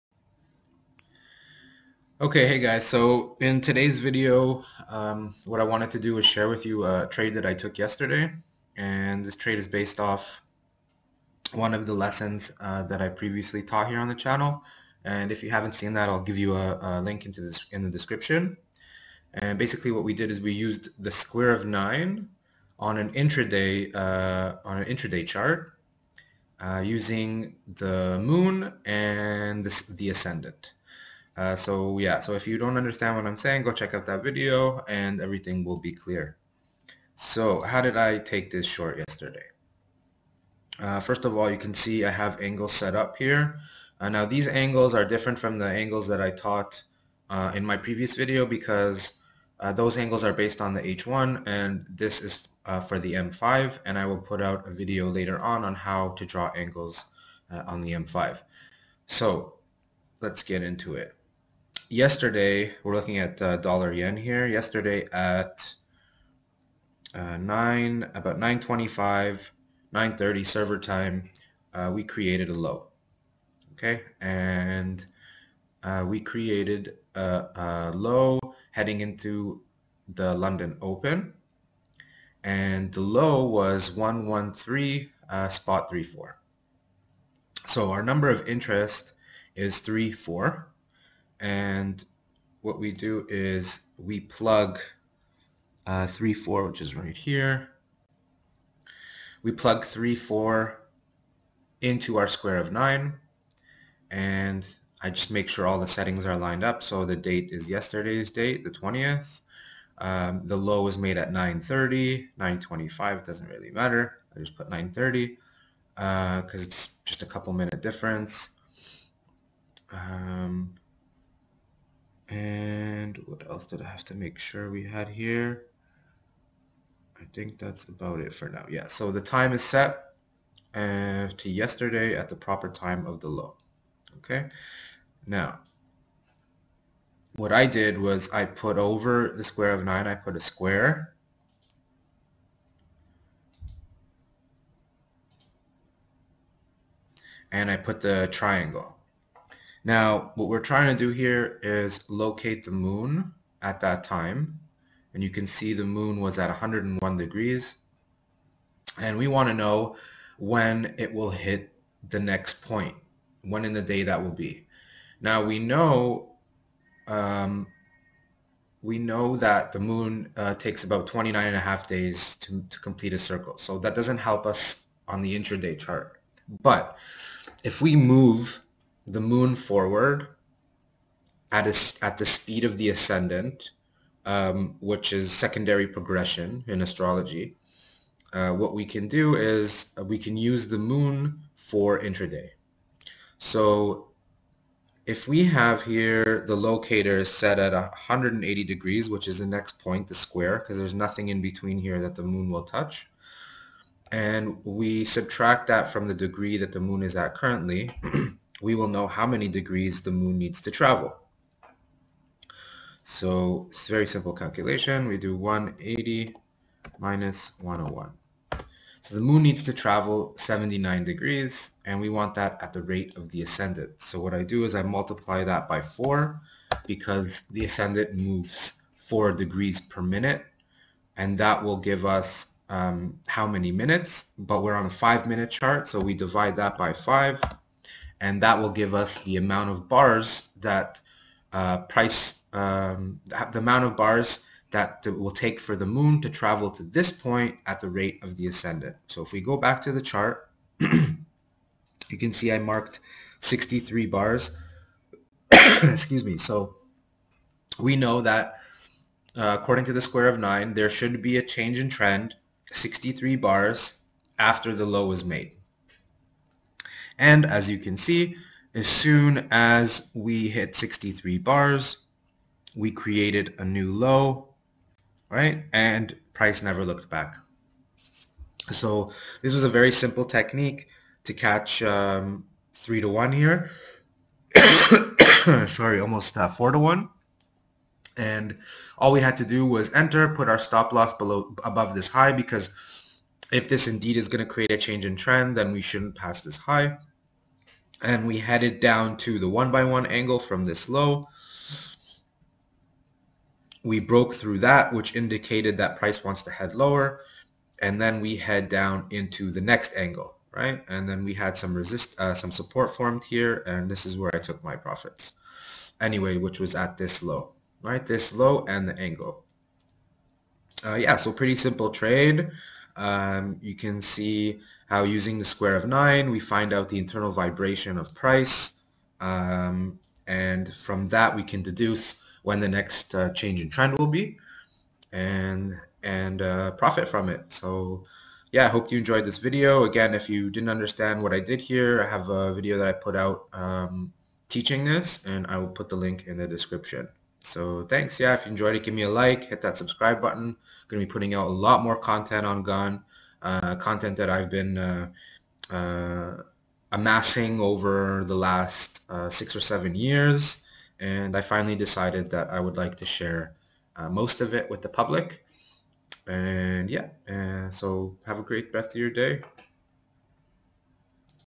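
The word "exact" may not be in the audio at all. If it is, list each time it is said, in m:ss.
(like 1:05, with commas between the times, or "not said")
not said.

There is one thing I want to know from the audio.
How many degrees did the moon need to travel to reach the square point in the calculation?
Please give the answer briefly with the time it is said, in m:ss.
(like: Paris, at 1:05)
79 degrees, at 3:40.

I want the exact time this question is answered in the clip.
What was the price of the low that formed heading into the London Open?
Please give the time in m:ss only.
1:23.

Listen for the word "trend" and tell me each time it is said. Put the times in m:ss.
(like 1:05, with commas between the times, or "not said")
4:21, 4:55, 5:33.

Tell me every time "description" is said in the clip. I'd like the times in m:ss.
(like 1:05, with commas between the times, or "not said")
0:17, 5:46.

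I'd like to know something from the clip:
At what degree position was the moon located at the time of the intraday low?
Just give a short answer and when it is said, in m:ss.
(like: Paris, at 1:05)
101 degrees, at 2:36.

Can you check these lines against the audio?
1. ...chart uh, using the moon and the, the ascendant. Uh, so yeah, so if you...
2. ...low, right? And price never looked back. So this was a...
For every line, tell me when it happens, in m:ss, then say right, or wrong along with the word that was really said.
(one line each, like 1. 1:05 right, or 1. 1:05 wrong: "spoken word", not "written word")
1. 0:25 right
2. 4:33 right.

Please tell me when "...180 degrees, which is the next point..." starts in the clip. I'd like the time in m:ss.
3:17.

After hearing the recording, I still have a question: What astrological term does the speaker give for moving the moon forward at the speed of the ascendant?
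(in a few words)
Secondary progression.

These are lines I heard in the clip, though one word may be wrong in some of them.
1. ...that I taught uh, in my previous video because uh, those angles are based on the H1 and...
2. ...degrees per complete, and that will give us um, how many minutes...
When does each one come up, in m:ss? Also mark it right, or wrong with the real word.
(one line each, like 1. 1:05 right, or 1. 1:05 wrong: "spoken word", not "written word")
1. 0:46 right
2. 3:49 wrong: "minute", not "complete".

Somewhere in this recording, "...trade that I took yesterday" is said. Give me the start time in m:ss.
0:07.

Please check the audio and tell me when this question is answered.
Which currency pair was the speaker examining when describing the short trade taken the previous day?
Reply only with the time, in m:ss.
1:03.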